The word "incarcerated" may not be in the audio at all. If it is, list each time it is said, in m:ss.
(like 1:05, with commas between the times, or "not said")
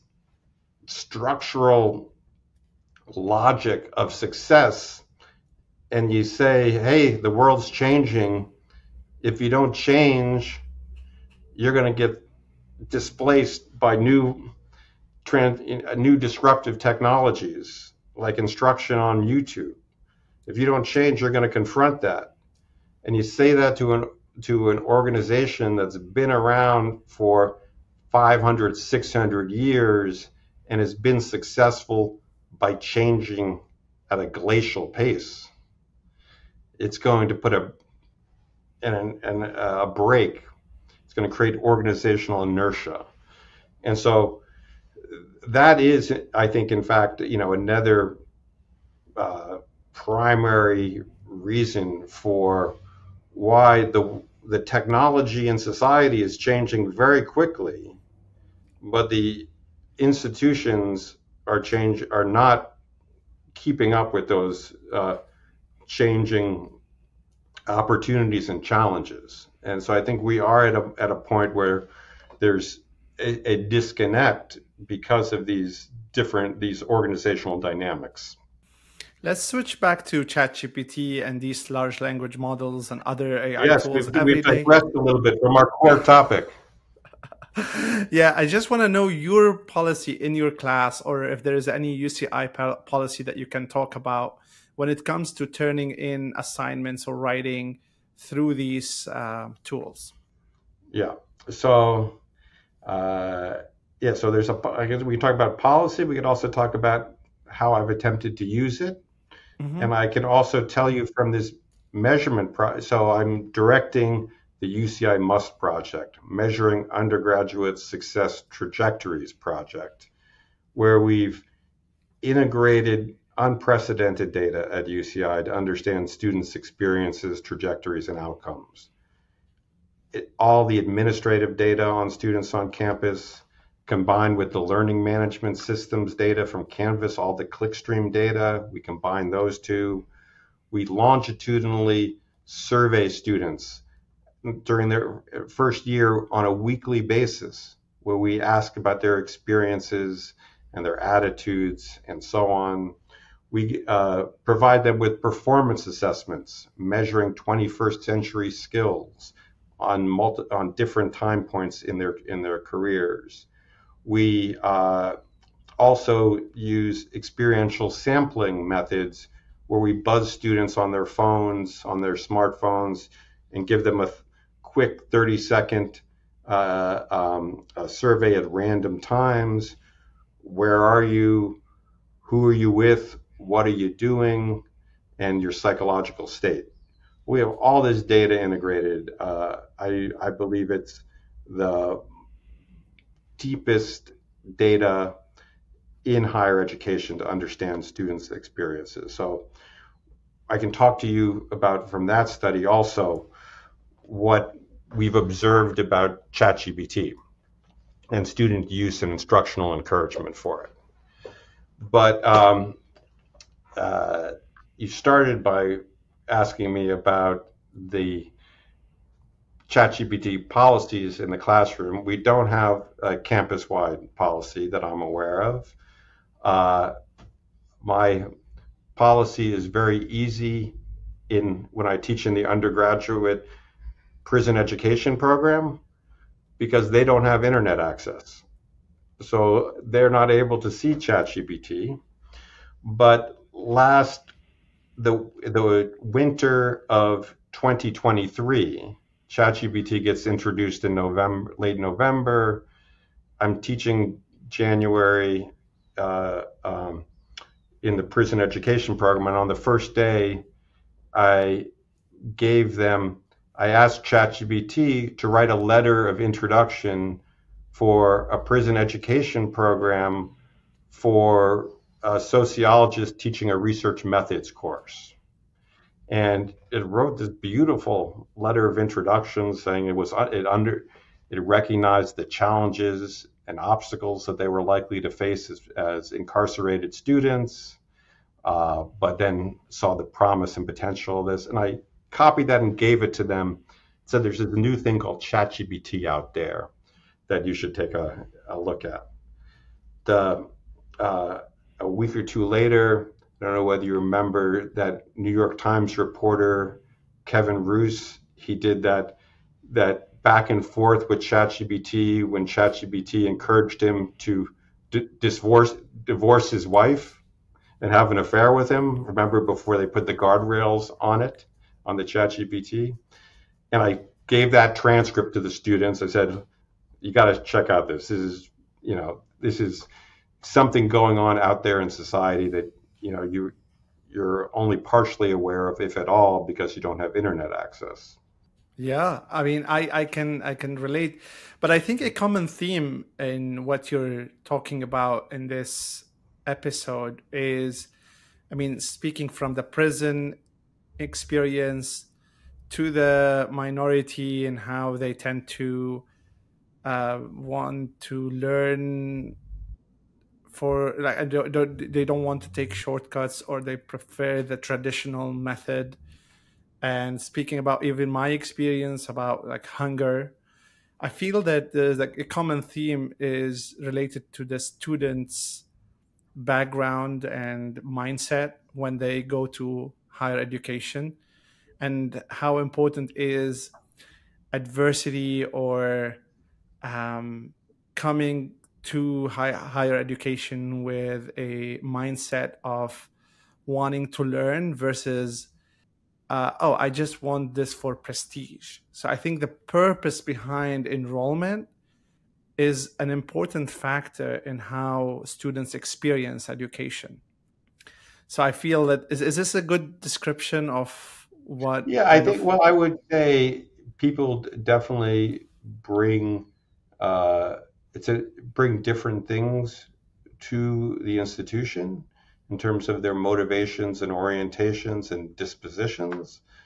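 4:46.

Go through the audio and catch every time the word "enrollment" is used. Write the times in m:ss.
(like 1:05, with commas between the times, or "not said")
6:40.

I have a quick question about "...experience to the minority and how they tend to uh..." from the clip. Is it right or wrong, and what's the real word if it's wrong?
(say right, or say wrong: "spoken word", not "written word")
right.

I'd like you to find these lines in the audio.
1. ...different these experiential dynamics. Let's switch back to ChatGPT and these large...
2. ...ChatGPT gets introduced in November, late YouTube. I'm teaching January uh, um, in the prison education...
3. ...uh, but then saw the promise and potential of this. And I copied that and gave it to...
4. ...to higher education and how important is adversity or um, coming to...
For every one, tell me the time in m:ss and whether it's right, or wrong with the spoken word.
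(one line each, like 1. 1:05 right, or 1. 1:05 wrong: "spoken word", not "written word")
1. 1:16 wrong: "organizational", not "experiential"
2. 4:09 wrong: "November", not "YouTube"
3. 4:48 right
4. 6:19 right.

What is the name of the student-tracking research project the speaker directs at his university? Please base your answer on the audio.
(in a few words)
UCI MUST.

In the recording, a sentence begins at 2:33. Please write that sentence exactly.
We uh, provide them with performance assessments measuring 21st century skills on multi, on different time points in their in their careers.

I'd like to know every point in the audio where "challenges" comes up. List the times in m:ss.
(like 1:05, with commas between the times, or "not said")
1:08, 4:42.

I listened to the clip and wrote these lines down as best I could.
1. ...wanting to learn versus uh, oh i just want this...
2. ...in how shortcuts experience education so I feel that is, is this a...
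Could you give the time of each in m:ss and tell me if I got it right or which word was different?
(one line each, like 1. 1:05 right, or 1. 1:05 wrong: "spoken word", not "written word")
1. 6:33 right
2. 6:44 wrong: "students", not "shortcuts".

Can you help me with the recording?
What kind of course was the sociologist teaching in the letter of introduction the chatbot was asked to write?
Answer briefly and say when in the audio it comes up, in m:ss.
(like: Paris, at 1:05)
research methods, at 4:33.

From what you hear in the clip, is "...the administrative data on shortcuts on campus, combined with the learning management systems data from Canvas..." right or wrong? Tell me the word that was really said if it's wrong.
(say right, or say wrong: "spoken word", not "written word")
wrong: "students", not "shortcuts".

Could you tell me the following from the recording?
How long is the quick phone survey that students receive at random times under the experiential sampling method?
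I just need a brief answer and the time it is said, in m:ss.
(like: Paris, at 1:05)
30 seconds, at 2:55.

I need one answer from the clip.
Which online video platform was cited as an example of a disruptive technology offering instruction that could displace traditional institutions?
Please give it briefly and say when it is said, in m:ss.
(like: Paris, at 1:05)
YouTube, at 0:19.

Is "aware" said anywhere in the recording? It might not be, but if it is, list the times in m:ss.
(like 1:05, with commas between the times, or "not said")
3:45, 5:35.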